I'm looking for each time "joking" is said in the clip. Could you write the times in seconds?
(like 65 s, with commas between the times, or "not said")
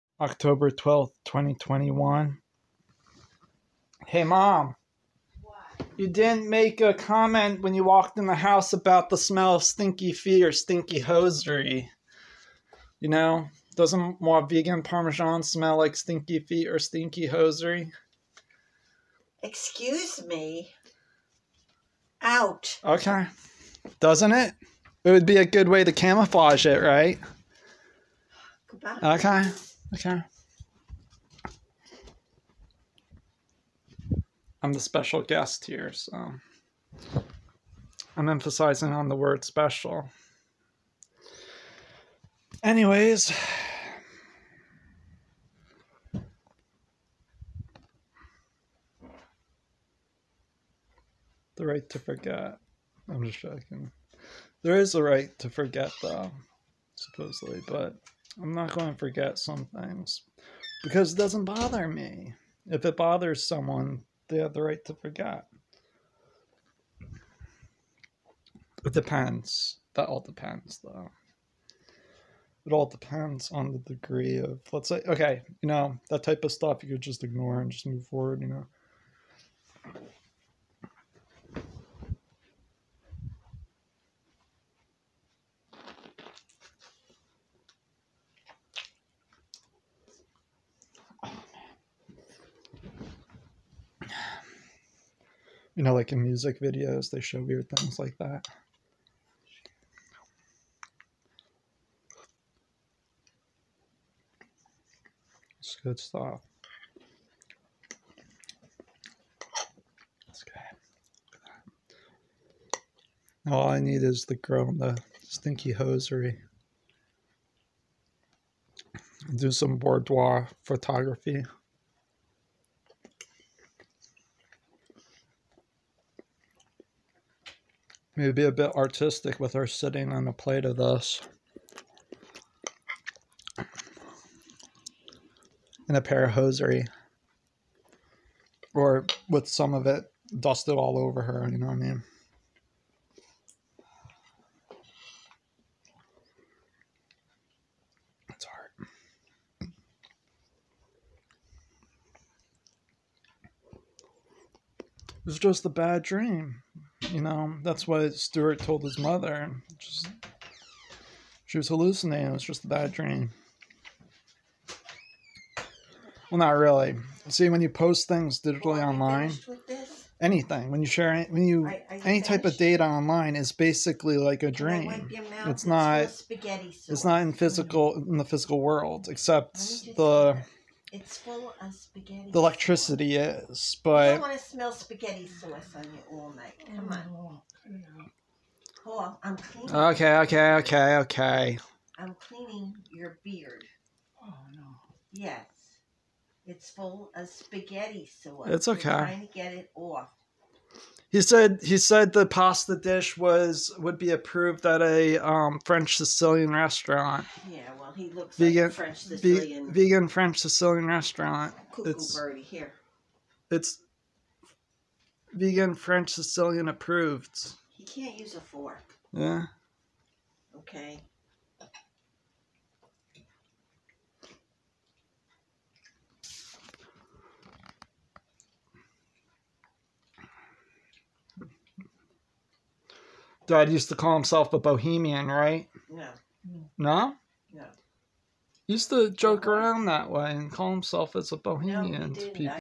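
53 s.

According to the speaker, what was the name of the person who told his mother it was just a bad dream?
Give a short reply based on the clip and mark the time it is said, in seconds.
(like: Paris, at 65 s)
Stuart, at 158 s.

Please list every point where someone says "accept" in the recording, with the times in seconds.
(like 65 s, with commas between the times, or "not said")
not said.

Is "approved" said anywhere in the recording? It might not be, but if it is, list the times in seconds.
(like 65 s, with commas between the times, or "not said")
204 s, 216 s.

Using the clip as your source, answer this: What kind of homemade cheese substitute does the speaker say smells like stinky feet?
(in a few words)
vegan parmesan.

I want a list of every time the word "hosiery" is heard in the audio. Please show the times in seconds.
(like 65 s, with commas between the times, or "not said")
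10 s, 17 s, 115 s, 136 s.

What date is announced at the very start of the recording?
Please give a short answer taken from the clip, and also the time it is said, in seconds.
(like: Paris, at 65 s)
October 12th, 2021, at 0 s.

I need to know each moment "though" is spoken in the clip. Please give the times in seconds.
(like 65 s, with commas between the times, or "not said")
56 s, 70 s.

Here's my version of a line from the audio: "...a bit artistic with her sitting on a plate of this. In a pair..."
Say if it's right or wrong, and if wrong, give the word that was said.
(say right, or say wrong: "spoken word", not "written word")
right.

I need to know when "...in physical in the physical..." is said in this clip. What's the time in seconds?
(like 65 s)
177 s.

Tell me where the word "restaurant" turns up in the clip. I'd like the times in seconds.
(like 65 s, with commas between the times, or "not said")
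206 s, 210 s.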